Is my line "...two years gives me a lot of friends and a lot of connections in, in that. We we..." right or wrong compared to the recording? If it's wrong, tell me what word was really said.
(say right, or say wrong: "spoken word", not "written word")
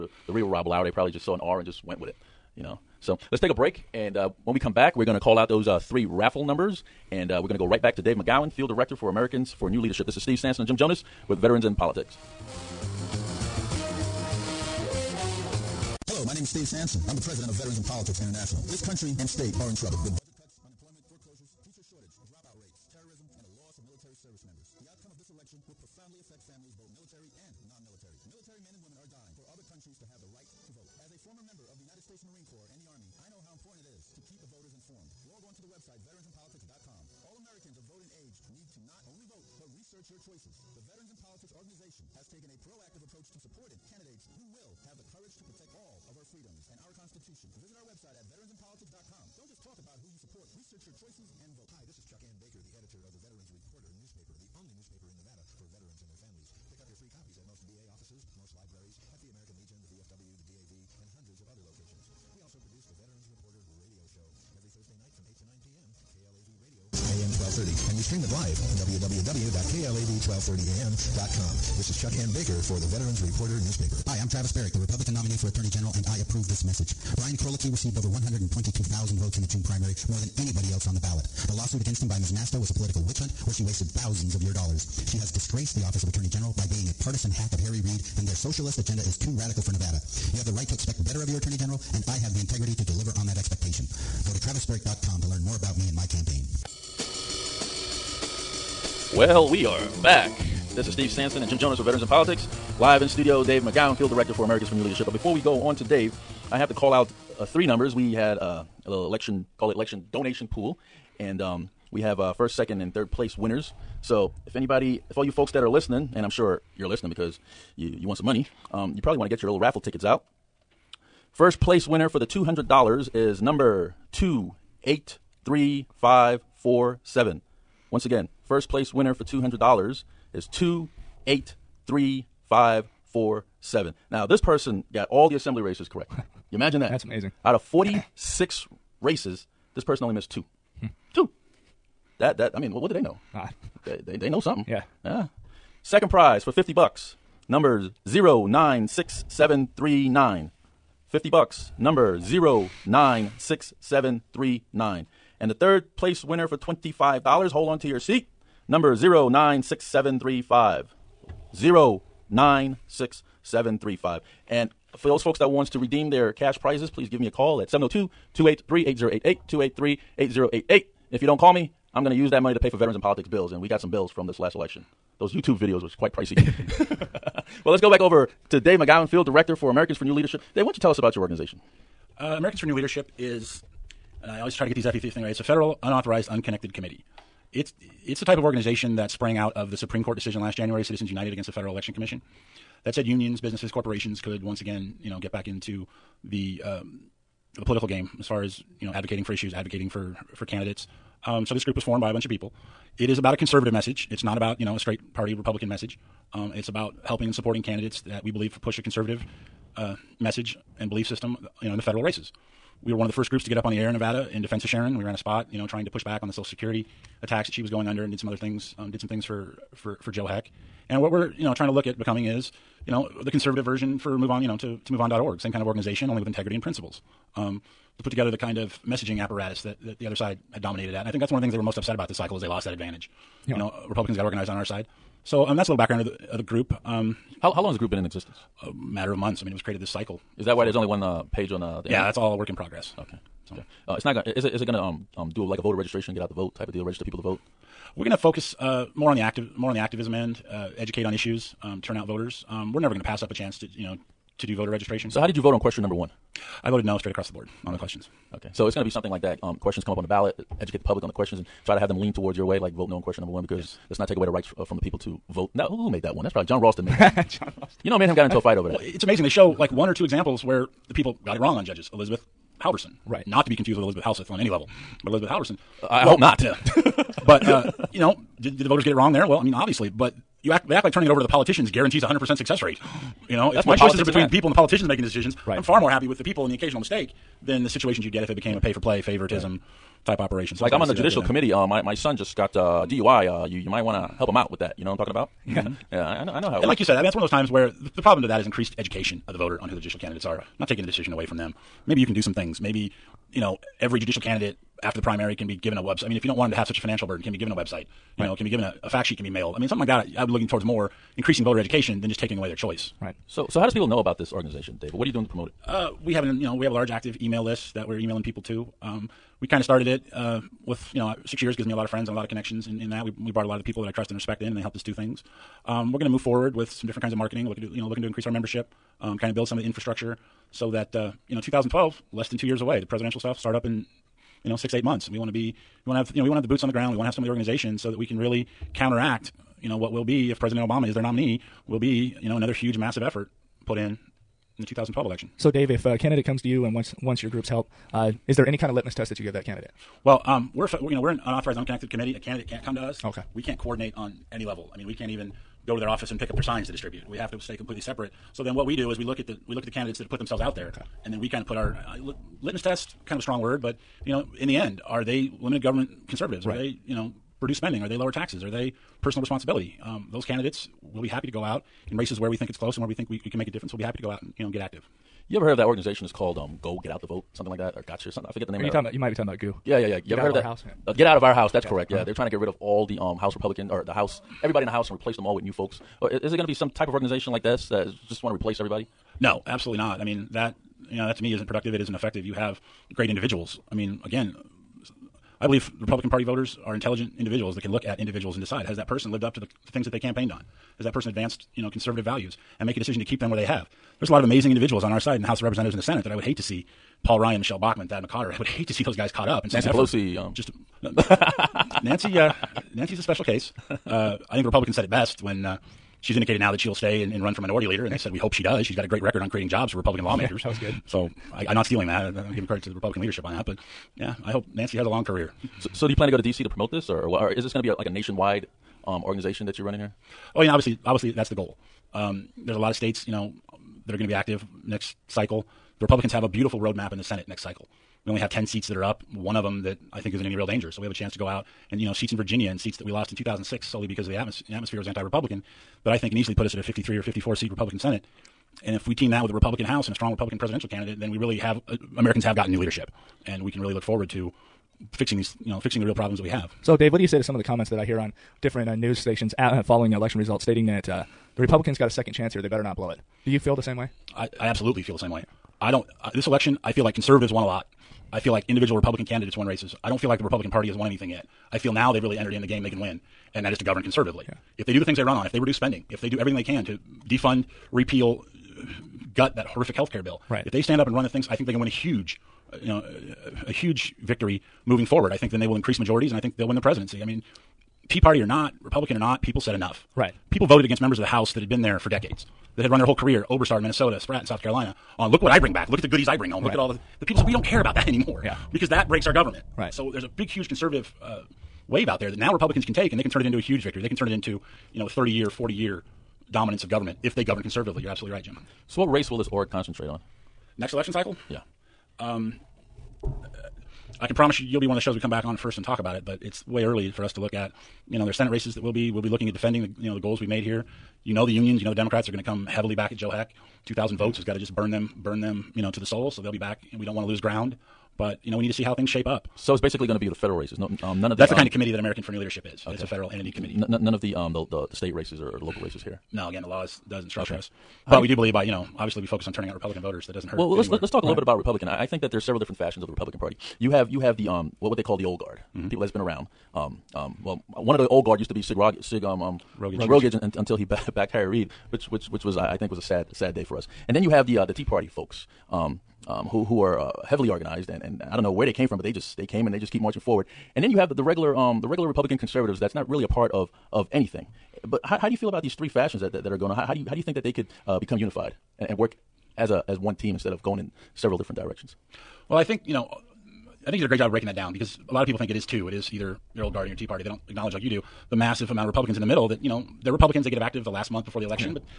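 wrong: "six", not "two".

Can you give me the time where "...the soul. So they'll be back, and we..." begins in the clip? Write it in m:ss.
8:45.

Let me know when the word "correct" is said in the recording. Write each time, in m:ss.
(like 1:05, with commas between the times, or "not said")
2:15, 6:21.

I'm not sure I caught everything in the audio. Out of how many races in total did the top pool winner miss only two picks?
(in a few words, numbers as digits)
46.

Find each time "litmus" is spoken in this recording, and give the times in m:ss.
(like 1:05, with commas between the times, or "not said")
5:48, 6:02.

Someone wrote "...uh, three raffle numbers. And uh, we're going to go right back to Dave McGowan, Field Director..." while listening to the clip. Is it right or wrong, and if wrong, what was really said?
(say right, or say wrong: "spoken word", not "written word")
right.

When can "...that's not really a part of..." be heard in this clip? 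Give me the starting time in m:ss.
9:22.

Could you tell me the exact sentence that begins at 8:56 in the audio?
No, again, the law doesn't structure okay.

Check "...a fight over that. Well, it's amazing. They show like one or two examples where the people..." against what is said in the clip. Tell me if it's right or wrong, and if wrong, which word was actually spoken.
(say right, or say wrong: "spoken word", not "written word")
right.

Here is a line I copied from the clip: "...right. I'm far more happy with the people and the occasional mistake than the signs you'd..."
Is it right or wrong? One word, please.
wrong.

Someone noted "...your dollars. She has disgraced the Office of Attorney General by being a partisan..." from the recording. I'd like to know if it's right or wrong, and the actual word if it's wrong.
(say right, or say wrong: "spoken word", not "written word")
right.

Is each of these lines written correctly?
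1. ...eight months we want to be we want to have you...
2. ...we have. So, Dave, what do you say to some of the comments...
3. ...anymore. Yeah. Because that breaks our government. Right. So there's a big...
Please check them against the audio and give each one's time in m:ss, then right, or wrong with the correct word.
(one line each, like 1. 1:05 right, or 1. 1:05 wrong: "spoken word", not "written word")
1. 5:34 right
2. 7:36 right
3. 8:17 right.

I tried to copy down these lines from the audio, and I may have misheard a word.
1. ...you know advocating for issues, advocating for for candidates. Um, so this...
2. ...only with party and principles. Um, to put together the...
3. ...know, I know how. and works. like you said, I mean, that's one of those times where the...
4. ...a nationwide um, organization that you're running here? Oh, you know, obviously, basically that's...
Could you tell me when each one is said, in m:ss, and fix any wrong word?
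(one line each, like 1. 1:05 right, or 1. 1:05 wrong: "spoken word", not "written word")
1. 3:18 right
2. 3:46 wrong: "integrity", not "party"
3. 4:56 right
4. 7:07 wrong: "obviously", not "basically".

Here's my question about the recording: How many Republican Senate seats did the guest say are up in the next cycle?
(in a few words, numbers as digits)
10.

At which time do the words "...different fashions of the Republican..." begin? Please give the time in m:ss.
9:02.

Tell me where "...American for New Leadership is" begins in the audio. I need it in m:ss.
8:51.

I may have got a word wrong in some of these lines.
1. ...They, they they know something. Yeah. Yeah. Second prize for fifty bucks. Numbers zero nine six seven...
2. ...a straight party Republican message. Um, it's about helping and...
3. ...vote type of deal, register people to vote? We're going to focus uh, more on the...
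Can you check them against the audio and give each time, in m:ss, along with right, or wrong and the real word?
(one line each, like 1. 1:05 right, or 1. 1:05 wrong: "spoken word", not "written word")
1. 2:23 right
2. 3:24 right
3. 4:06 right.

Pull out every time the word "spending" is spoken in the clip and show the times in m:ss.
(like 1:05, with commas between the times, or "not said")
6:07, 7:55.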